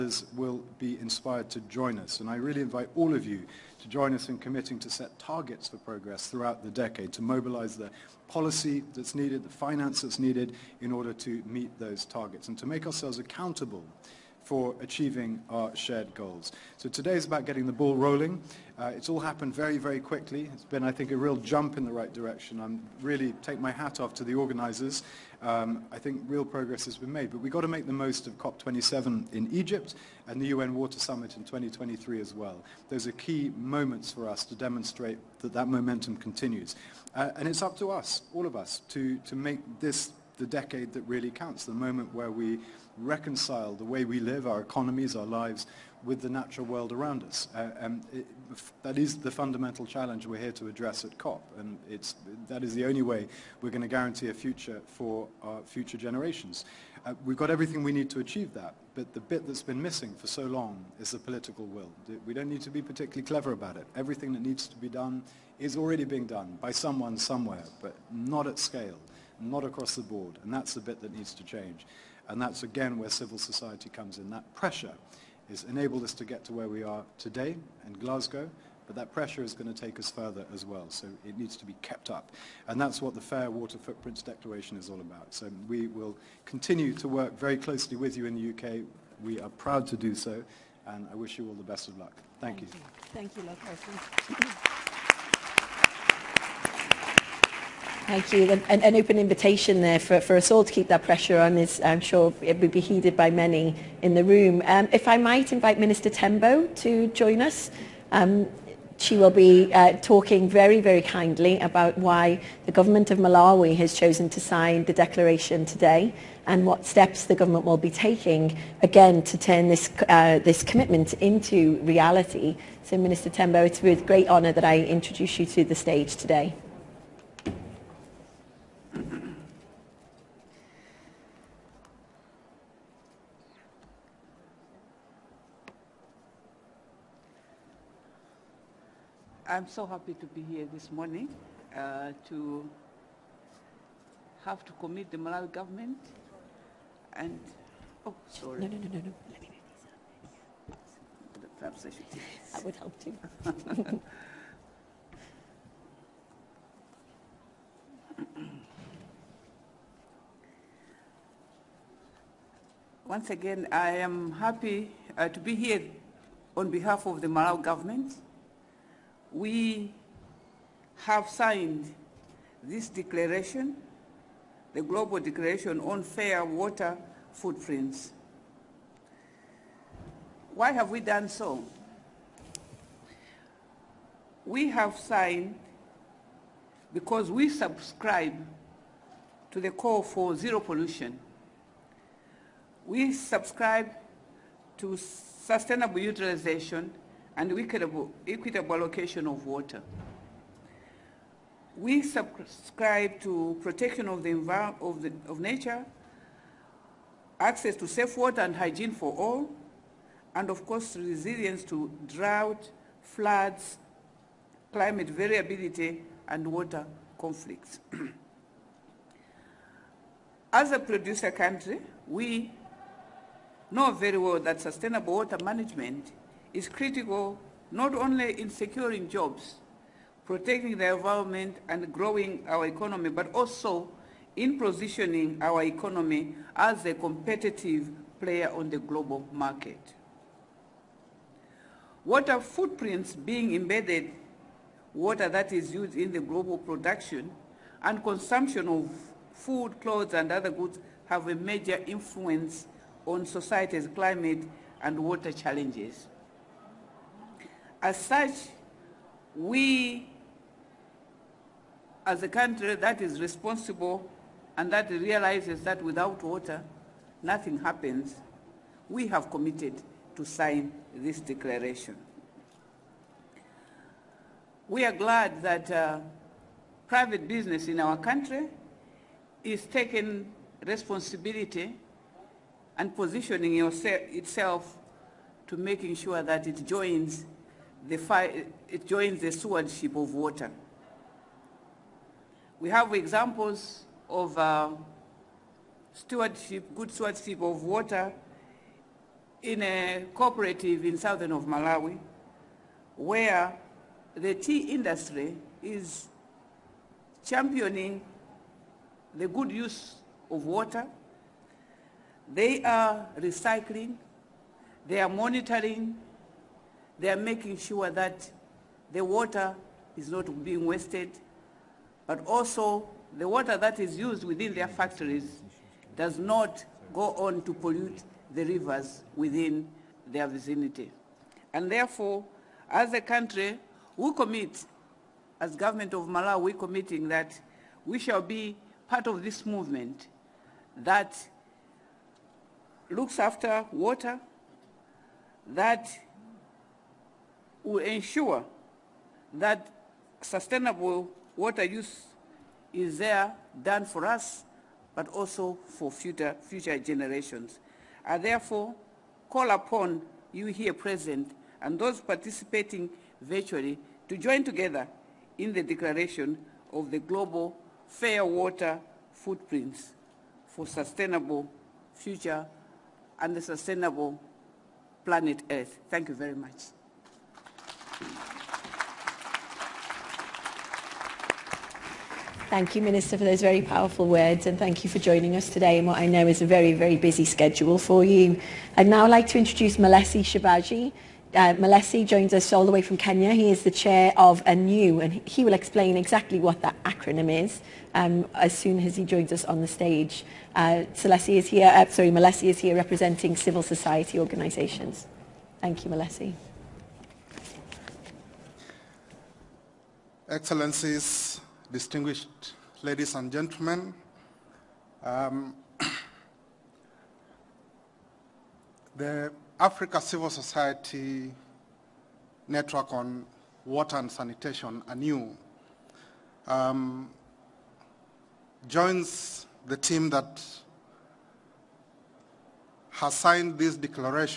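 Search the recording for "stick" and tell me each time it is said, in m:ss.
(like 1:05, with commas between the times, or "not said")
not said.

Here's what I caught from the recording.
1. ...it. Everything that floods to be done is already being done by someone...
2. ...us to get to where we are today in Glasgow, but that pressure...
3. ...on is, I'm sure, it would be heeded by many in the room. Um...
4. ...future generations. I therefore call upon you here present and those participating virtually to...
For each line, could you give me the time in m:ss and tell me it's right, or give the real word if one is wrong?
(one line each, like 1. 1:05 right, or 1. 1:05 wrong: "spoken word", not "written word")
1. 1:03 wrong: "needs", not "floods"
2. 1:16 right
3. 1:41 right
4. 5:56 right.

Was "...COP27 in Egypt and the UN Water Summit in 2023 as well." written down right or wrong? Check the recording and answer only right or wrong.
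right.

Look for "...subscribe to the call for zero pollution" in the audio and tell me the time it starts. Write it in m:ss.
3:07.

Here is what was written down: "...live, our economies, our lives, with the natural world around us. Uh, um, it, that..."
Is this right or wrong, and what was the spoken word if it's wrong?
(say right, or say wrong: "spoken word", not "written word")
right.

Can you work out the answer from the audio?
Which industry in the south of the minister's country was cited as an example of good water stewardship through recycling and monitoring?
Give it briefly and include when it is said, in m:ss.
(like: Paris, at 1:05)
Tea industry, at 5:04.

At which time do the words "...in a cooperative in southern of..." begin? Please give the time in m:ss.
4:59.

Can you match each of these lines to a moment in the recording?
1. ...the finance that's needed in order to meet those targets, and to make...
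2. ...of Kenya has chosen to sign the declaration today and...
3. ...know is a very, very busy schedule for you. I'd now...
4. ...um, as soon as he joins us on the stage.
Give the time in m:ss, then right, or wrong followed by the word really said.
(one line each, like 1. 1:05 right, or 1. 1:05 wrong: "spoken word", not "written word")
1. 0:09 right
2. 1:53 wrong: "Malawi", not "Kenya"
3. 6:26 right
4. 6:37 right.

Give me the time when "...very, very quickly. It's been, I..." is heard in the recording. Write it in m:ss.
0:19.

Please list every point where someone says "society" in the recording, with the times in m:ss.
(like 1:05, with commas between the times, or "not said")
1:13, 4:13, 6:43, 7:00.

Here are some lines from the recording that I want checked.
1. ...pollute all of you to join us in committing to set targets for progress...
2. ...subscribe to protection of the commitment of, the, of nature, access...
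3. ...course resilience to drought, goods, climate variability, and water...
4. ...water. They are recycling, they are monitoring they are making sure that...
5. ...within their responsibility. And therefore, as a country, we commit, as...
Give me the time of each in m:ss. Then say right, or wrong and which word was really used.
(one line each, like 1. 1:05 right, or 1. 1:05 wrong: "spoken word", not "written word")
1. 0:02 wrong: "invite", not "pollute"
2. 3:22 wrong: "environment", not "commitment"
3. 3:30 wrong: "floods", not "goods"
4. 5:10 right
5. 5:29 wrong: "vicinity", not "responsibility".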